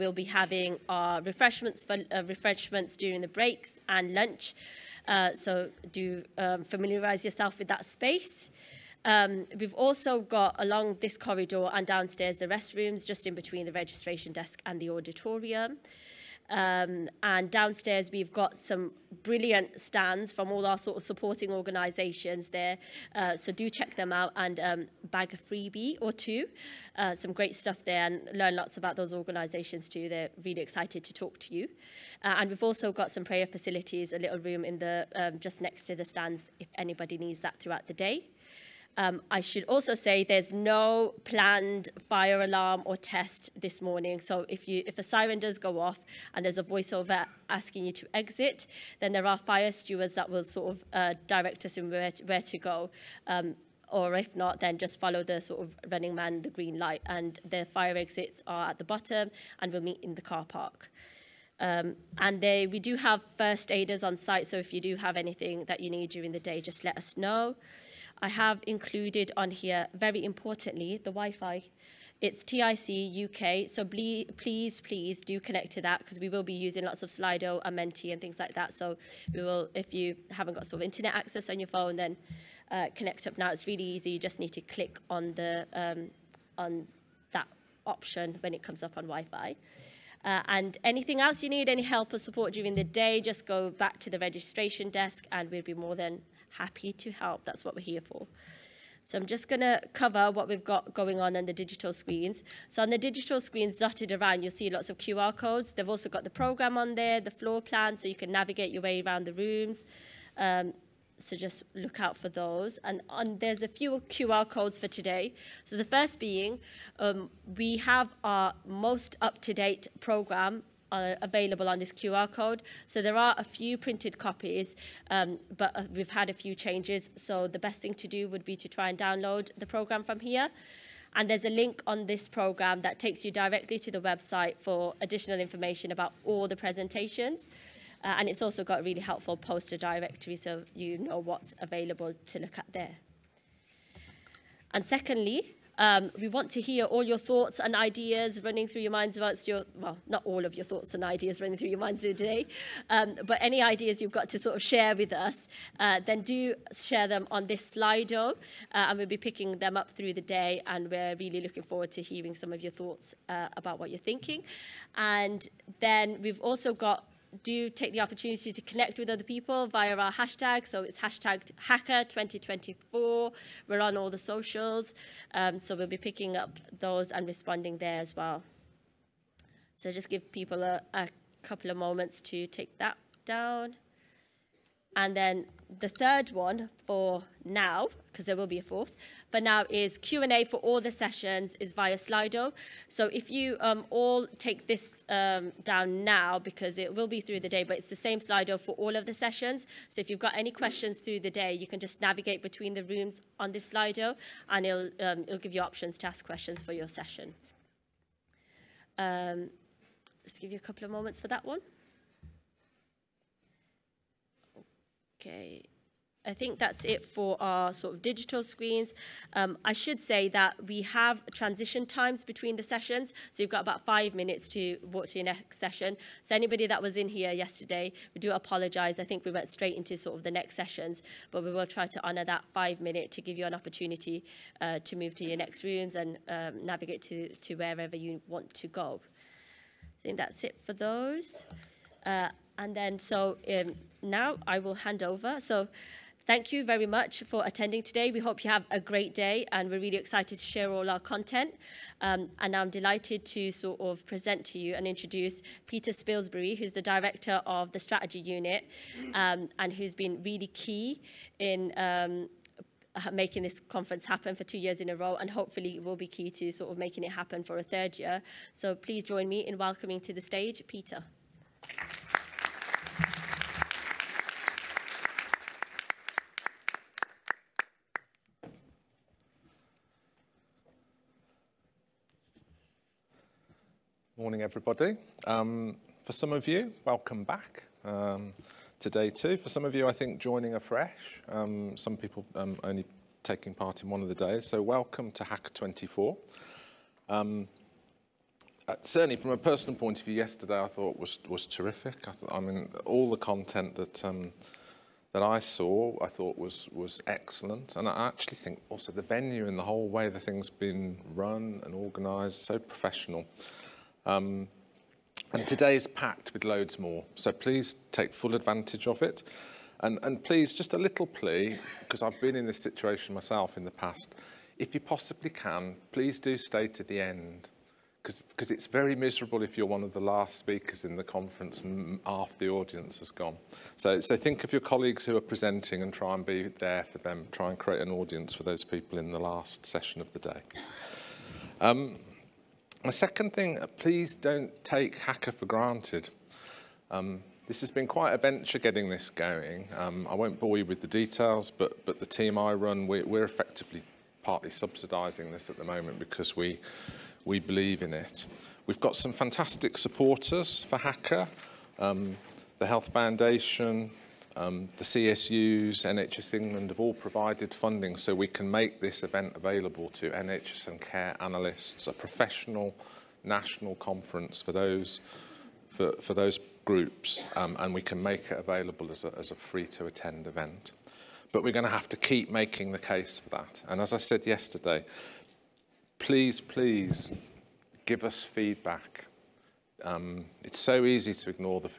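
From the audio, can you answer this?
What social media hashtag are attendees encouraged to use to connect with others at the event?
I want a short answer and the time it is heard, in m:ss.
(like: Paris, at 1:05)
#HACA2024, at 2:51.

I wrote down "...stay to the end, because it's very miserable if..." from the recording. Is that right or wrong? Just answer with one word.
right.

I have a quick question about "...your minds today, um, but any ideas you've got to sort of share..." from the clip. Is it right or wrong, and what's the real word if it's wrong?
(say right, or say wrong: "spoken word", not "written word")
right.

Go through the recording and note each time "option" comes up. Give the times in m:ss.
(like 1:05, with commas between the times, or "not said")
1:27, 3:25.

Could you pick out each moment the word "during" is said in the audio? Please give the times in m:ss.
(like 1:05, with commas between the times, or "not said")
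0:02, 1:06, 1:32.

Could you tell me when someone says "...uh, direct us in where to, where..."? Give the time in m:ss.
0:50.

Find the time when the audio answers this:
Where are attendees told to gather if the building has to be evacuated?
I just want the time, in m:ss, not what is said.
1:00.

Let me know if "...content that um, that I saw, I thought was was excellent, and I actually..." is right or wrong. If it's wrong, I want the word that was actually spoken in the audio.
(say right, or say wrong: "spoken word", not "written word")
right.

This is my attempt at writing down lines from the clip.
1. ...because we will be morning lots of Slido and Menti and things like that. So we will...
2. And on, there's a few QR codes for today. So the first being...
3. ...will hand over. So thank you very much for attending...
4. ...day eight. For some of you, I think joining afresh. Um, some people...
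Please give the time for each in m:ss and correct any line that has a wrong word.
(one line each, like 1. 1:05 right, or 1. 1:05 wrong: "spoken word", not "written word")
1. 1:15 wrong: "using", not "morning"
2. 1:52 right
3. 4:04 right
4. 4:48 wrong: "two", not "eight".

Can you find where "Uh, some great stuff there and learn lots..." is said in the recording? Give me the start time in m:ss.
0:26.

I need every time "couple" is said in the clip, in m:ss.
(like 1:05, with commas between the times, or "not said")
3:01, 3:30.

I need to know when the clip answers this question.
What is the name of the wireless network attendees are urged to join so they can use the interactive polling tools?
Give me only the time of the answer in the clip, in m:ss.
1:12.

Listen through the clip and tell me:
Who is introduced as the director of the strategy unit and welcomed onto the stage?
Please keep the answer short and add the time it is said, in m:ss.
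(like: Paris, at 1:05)
Peter Spilsbury, at 4:15.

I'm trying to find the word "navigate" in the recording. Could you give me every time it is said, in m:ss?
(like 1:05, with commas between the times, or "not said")
1:48, 3:21, 3:56.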